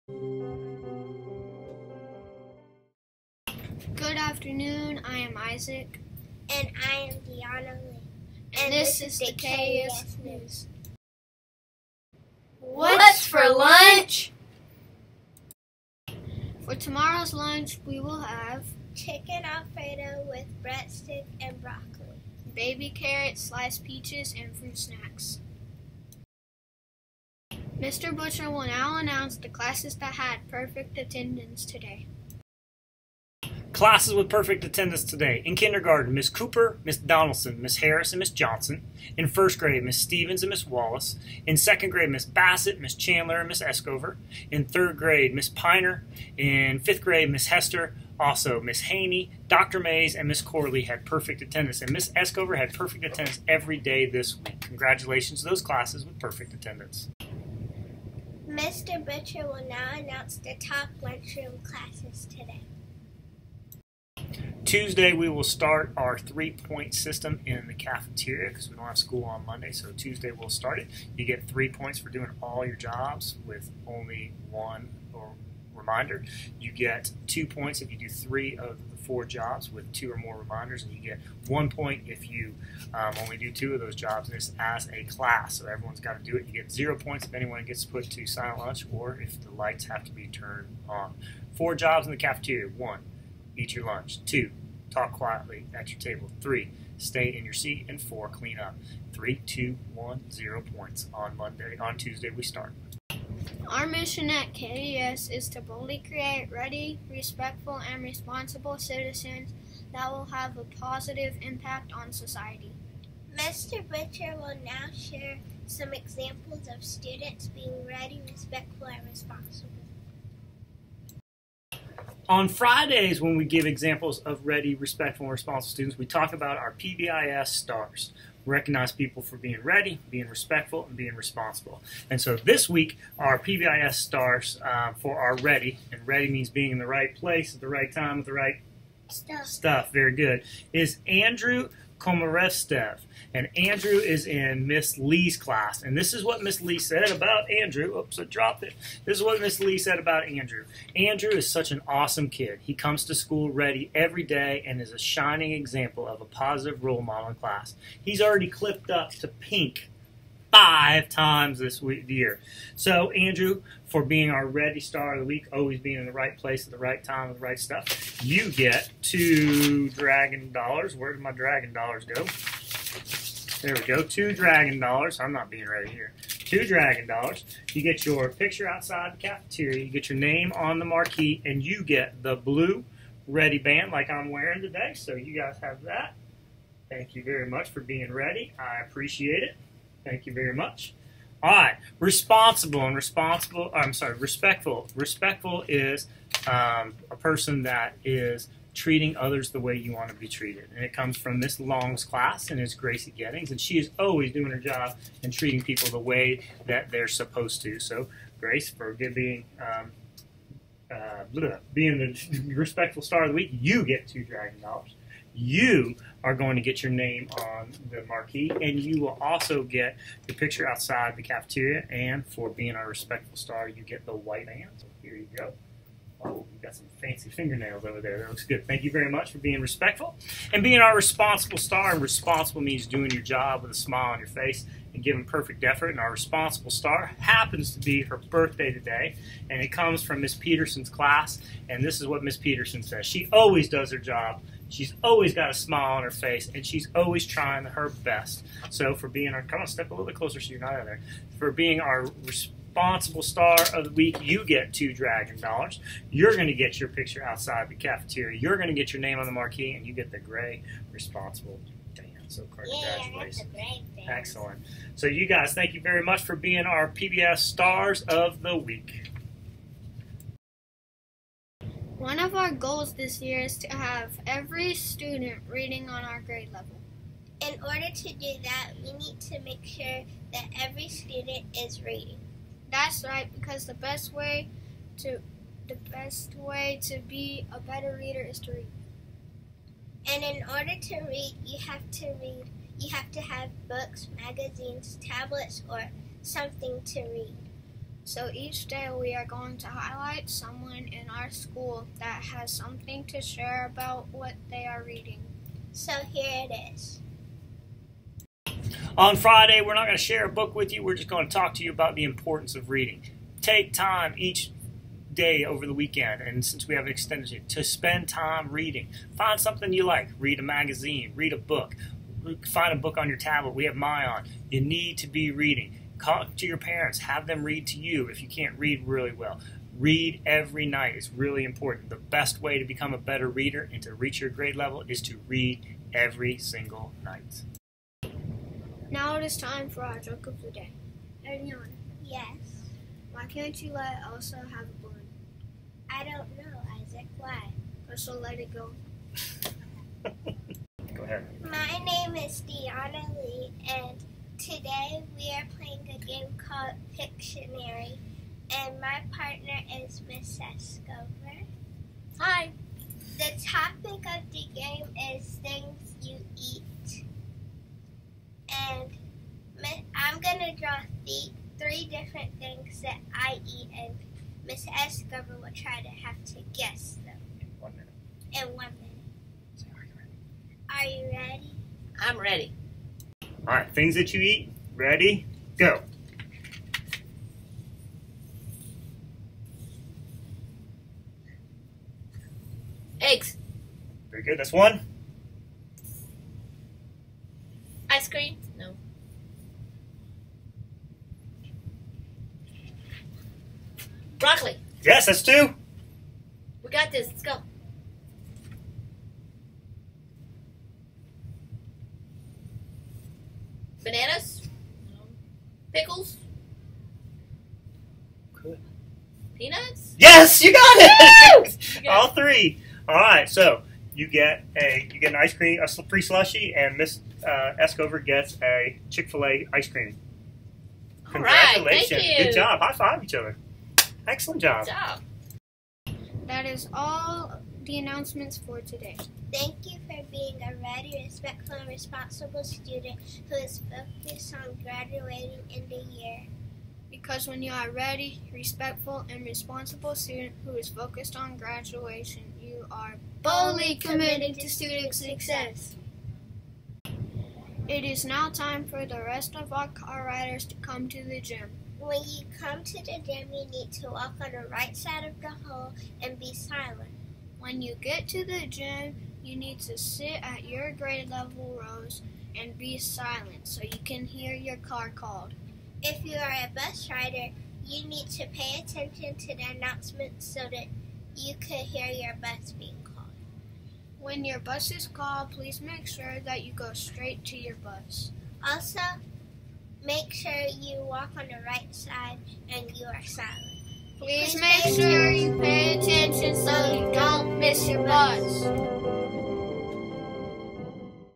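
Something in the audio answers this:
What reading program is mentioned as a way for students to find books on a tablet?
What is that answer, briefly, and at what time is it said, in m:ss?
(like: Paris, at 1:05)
myON, at 5:23.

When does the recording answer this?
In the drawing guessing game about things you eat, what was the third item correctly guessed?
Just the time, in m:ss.
6:59.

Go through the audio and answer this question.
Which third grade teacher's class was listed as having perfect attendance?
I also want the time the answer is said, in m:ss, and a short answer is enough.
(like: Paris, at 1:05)
Miss Piner, at 0:45.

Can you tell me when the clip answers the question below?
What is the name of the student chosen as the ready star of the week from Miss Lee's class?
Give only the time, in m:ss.
2:21.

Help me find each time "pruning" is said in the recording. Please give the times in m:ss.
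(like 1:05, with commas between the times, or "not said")
not said.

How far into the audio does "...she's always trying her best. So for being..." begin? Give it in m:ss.
4:06.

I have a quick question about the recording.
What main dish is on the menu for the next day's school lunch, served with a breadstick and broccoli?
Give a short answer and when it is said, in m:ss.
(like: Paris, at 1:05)
chicken alfredo, at 0:18.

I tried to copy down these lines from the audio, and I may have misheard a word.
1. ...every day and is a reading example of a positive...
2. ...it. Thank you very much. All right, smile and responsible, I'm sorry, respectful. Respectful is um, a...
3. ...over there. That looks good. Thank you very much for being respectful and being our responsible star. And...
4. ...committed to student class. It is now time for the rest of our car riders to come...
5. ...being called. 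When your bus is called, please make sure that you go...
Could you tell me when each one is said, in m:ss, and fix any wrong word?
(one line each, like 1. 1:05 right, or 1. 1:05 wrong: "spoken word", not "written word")
1. 2:33 wrong: "shining", not "reading"
2. 3:09 wrong: "responsible", not "smile"
3. 3:47 right
4. 7:33 wrong: "success", not "class"
5. 8:02 right.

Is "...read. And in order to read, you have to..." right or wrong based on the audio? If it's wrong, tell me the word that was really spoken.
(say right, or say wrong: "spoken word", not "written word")
right.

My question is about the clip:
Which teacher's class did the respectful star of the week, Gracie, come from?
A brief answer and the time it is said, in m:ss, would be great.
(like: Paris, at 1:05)
Miss Long, at 3:21.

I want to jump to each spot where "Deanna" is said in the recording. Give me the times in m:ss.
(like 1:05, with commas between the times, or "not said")
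0:07, 5:52.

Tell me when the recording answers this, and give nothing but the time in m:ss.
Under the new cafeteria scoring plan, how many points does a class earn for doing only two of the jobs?
1:21.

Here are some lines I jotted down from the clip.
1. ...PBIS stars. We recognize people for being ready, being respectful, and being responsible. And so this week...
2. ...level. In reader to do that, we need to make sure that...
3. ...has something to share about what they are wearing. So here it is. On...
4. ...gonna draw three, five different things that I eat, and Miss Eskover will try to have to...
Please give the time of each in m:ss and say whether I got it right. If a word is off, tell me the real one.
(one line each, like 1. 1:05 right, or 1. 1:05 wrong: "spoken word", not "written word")
1. 2:06 right
2. 4:36 wrong: "order", not "reader"
3. 5:02 wrong: "reading", not "wearing"
4. 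6:10 wrong: "three", not "five".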